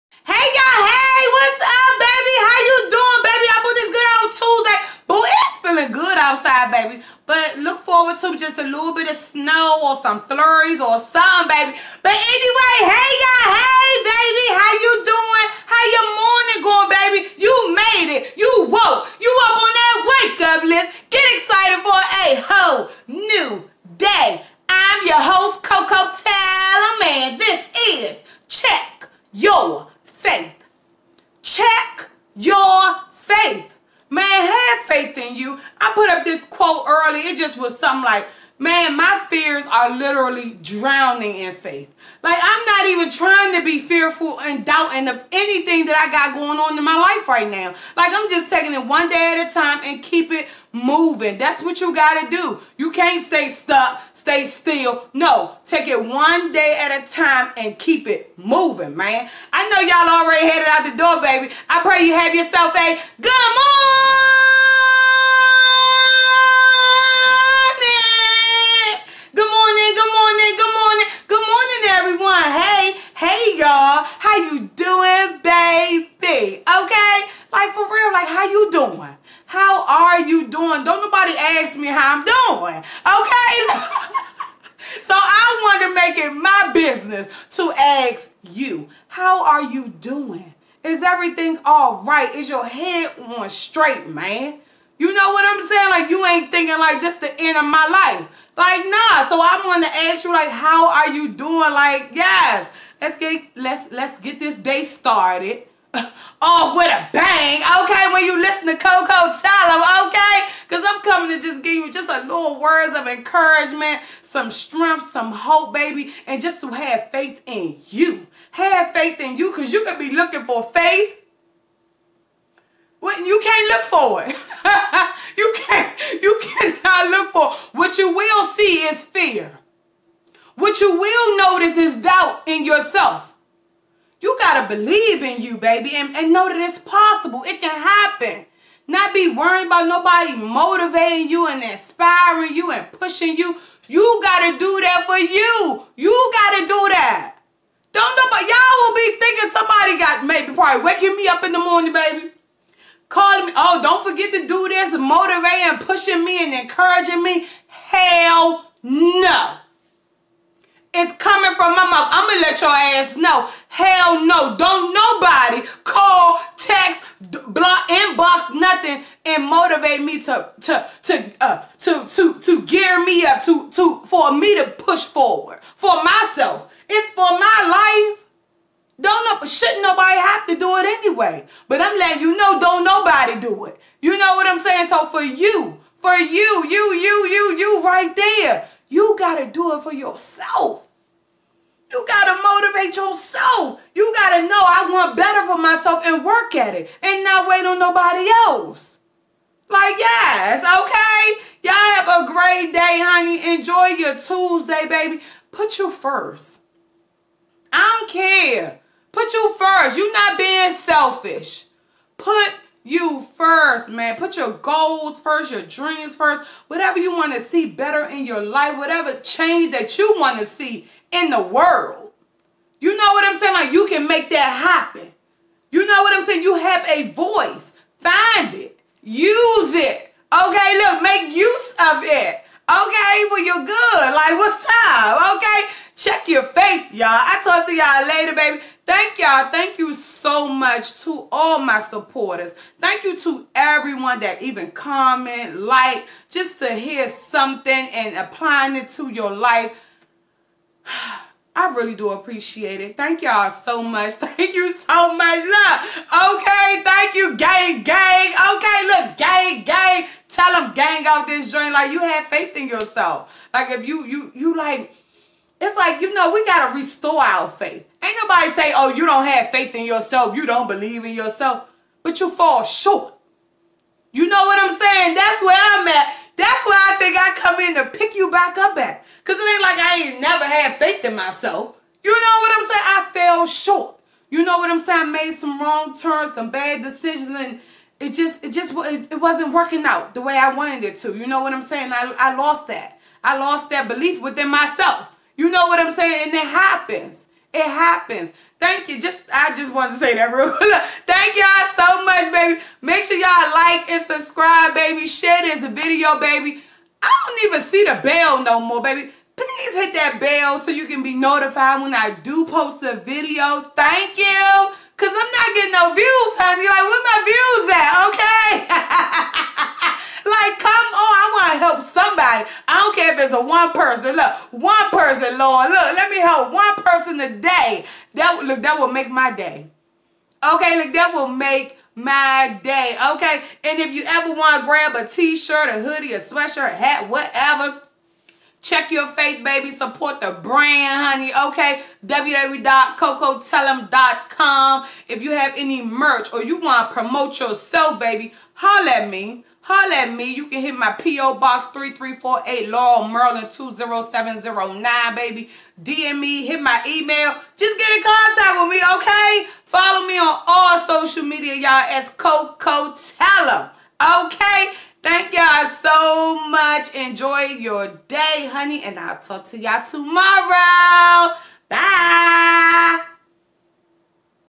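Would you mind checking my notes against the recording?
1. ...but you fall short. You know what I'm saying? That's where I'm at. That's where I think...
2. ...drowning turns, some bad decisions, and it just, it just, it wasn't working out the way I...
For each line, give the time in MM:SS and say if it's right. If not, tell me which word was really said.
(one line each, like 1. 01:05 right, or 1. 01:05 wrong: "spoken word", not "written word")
1. 04:32 right
2. 04:45 wrong: "wrong", not "drowning".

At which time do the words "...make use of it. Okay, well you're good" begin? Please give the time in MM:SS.
03:51.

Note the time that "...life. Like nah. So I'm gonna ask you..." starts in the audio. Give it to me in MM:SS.
01:37.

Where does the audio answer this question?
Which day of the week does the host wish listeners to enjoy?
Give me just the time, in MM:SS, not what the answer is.
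03:24.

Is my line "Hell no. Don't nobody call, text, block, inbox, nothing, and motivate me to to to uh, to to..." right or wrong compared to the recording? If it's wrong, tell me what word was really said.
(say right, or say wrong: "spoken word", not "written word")
right.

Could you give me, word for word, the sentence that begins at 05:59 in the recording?
Follow me on all social media, y'all, as Koko Tellem.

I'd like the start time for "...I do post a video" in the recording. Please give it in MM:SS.
05:11.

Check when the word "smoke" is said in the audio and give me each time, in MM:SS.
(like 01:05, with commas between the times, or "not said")
not said.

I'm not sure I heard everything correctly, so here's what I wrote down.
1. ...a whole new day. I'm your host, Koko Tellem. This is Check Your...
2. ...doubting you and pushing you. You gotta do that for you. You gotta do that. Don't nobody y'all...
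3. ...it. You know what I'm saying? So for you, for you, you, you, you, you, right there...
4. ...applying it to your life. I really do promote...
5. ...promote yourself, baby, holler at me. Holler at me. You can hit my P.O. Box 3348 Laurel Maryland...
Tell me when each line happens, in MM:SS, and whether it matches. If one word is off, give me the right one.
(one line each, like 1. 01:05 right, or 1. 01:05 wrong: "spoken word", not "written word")
1. 00:22 right
2. 02:21 wrong: "inspiring", not "doubting"
3. 03:03 right
4. 04:08 wrong: "appreciate", not "promote"
5. 05:46 right.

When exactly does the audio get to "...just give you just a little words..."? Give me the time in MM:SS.
01:51.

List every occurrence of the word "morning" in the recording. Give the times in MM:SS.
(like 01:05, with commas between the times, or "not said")
00:16, 01:03, 02:31.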